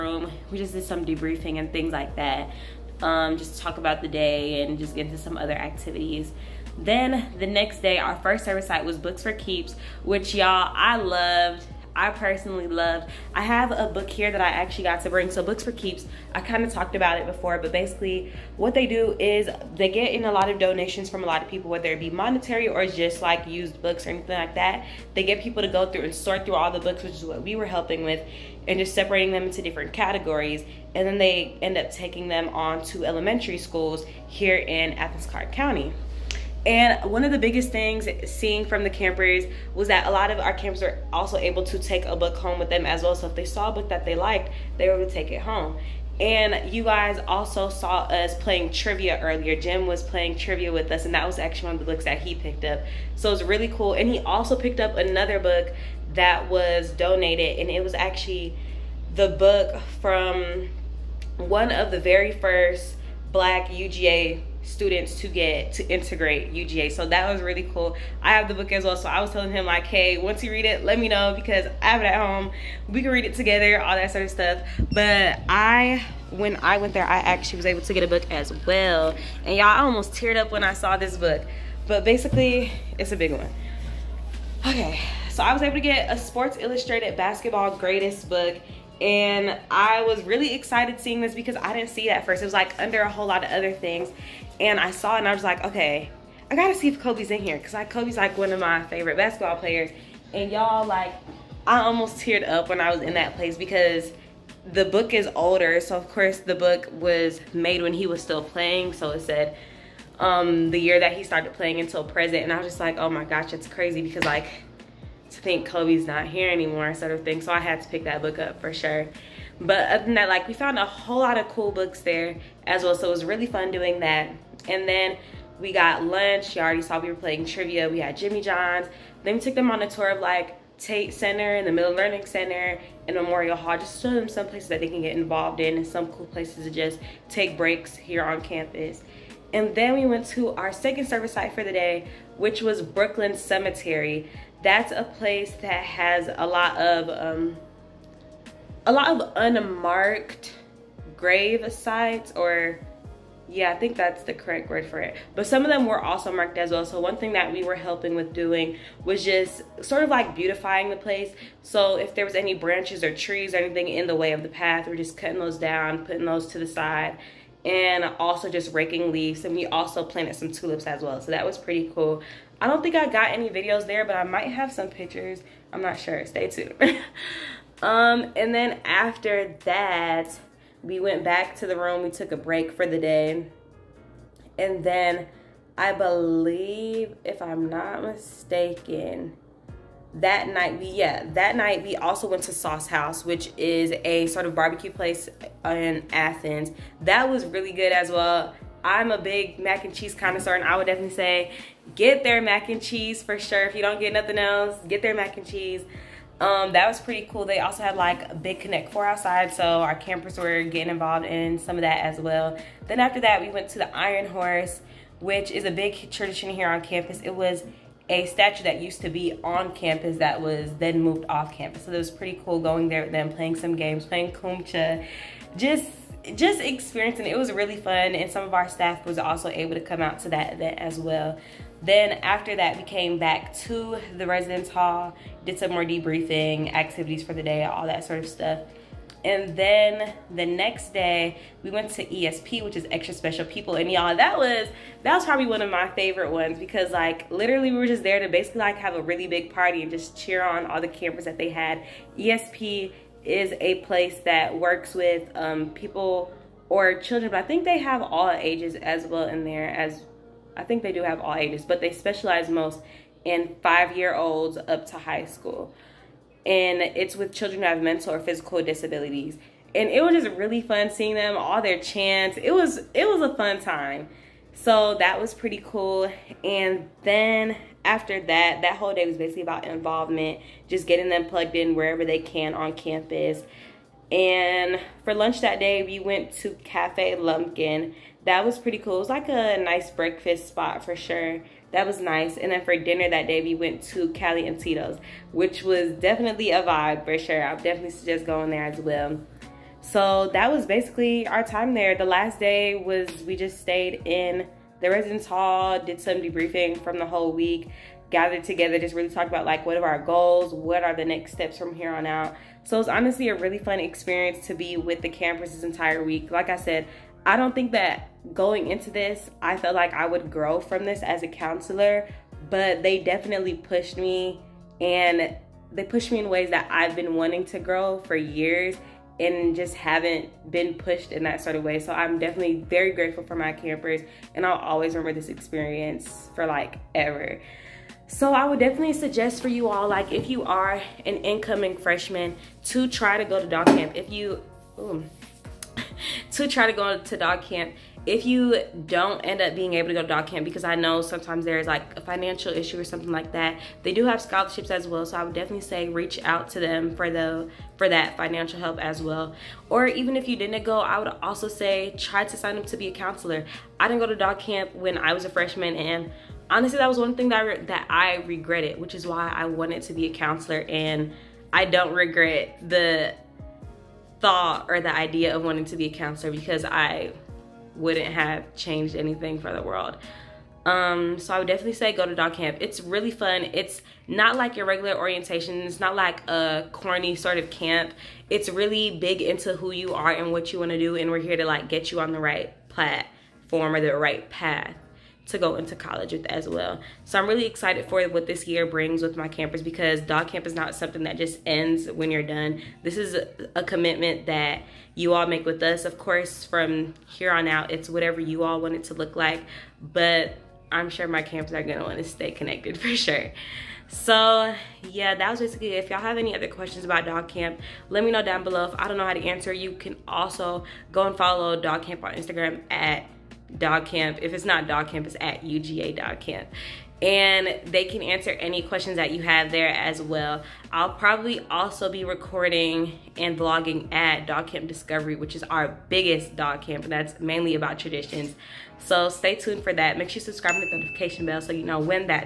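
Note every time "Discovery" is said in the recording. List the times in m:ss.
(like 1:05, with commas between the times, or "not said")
7:14.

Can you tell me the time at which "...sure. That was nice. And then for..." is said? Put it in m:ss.
4:50.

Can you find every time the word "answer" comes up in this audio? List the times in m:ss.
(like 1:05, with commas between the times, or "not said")
6:59, 7:08.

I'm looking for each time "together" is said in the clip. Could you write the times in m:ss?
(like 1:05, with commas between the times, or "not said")
1:13, 5:08.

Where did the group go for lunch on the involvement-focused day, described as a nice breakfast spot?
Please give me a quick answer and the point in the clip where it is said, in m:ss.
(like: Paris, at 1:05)
Cafe Lumpkin, at 4:46.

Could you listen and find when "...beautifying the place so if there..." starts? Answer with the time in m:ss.
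2:40.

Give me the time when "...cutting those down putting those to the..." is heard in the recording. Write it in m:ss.
2:45.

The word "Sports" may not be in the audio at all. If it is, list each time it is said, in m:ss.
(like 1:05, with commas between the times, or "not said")
1:26.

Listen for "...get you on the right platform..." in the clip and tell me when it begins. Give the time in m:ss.
6:31.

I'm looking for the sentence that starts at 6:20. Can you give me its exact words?
Um, so I would definitely say go to Dawg Camp.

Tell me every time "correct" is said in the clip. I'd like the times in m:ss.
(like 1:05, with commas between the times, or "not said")
2:34.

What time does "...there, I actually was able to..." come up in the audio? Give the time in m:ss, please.
1:16.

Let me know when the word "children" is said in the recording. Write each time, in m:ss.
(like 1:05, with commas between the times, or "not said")
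4:16, 4:27.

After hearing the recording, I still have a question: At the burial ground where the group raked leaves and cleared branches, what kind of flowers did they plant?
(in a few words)
Tulips.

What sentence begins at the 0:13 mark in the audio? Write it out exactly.
I have a book here that I actually got to bring.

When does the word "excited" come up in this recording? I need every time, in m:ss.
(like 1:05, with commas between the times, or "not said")
1:30, 6:37.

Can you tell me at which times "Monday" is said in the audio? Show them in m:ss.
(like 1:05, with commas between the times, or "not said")
not said.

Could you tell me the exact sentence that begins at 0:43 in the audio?
So if they saw a book that they liked, they were able to take it home.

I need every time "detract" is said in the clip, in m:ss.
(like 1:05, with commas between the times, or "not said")
not said.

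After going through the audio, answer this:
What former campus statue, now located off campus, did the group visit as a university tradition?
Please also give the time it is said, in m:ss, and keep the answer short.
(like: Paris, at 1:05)
The Iron Horse, at 3:33.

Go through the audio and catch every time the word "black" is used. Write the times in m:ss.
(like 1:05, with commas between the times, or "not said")
1:03.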